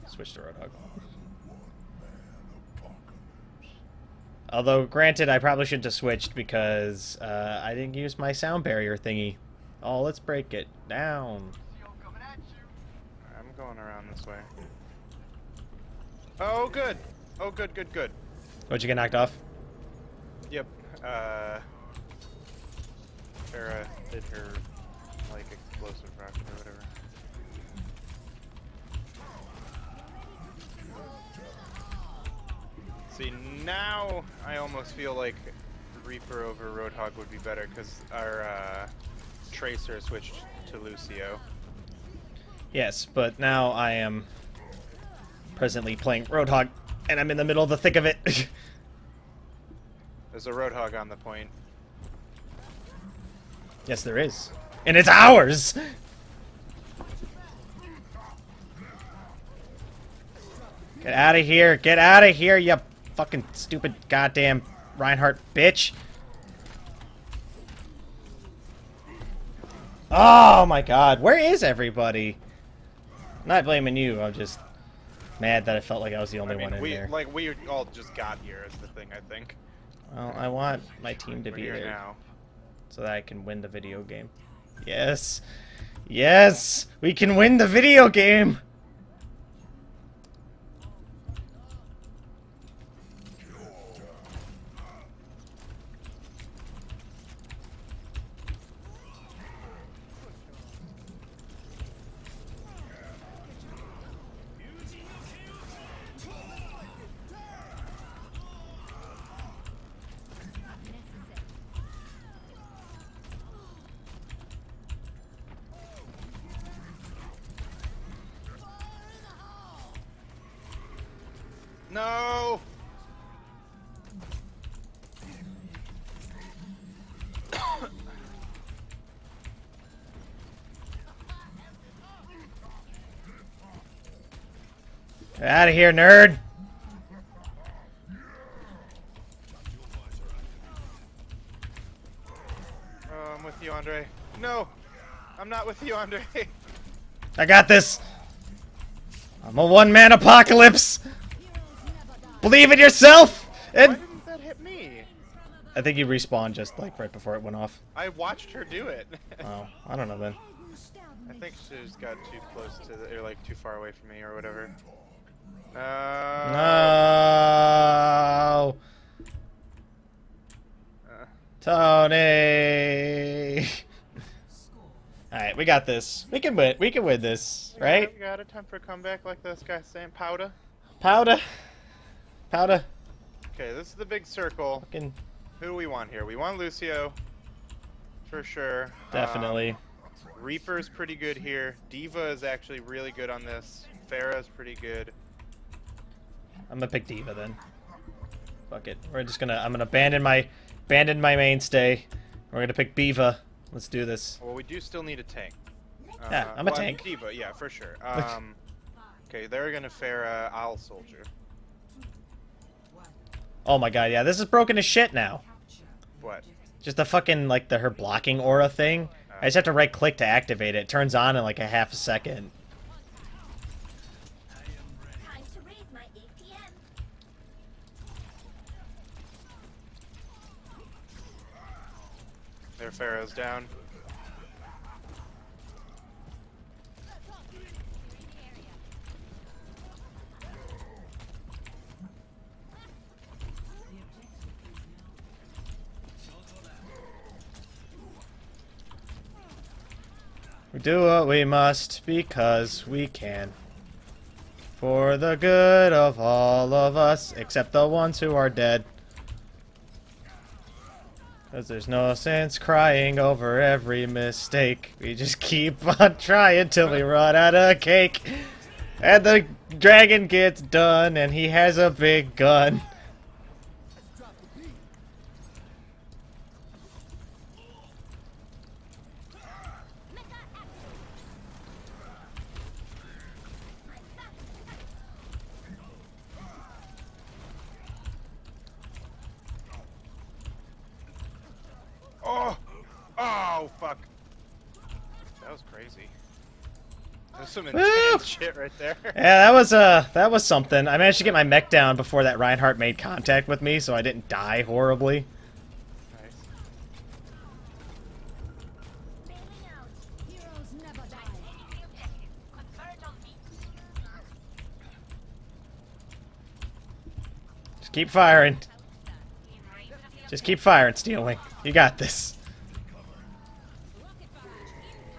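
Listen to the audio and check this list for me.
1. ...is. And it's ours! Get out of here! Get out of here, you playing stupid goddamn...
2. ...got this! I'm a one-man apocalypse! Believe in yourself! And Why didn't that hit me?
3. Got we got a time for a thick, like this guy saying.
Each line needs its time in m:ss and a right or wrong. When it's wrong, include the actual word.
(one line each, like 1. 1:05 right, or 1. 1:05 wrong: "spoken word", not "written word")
1. 0:54 wrong: "fucking", not "playing"
2. 2:27 right
3. 2:58 wrong: "comeback", not "thick".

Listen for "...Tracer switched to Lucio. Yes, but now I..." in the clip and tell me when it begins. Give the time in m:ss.
0:39.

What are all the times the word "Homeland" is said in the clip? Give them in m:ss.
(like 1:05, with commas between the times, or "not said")
not said.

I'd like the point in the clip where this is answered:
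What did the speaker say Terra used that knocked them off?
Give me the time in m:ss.
0:25.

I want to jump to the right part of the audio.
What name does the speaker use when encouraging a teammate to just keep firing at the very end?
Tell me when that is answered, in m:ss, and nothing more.
5:20.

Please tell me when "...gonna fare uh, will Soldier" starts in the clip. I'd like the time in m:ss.
3:29.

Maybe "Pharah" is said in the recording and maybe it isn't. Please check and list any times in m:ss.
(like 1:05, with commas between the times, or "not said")
3:14, 3:52.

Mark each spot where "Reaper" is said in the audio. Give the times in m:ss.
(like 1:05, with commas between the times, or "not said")
0:36, 3:10.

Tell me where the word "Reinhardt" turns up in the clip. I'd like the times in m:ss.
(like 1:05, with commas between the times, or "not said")
1:04, 5:02.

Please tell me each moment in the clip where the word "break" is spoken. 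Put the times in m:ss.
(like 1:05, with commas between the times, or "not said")
0:10.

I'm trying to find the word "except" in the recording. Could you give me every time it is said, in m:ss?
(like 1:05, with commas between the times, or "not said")
4:17.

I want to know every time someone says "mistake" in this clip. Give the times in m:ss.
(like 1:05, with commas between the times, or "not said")
4:24.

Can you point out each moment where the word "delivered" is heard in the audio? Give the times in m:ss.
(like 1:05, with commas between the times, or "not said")
not said.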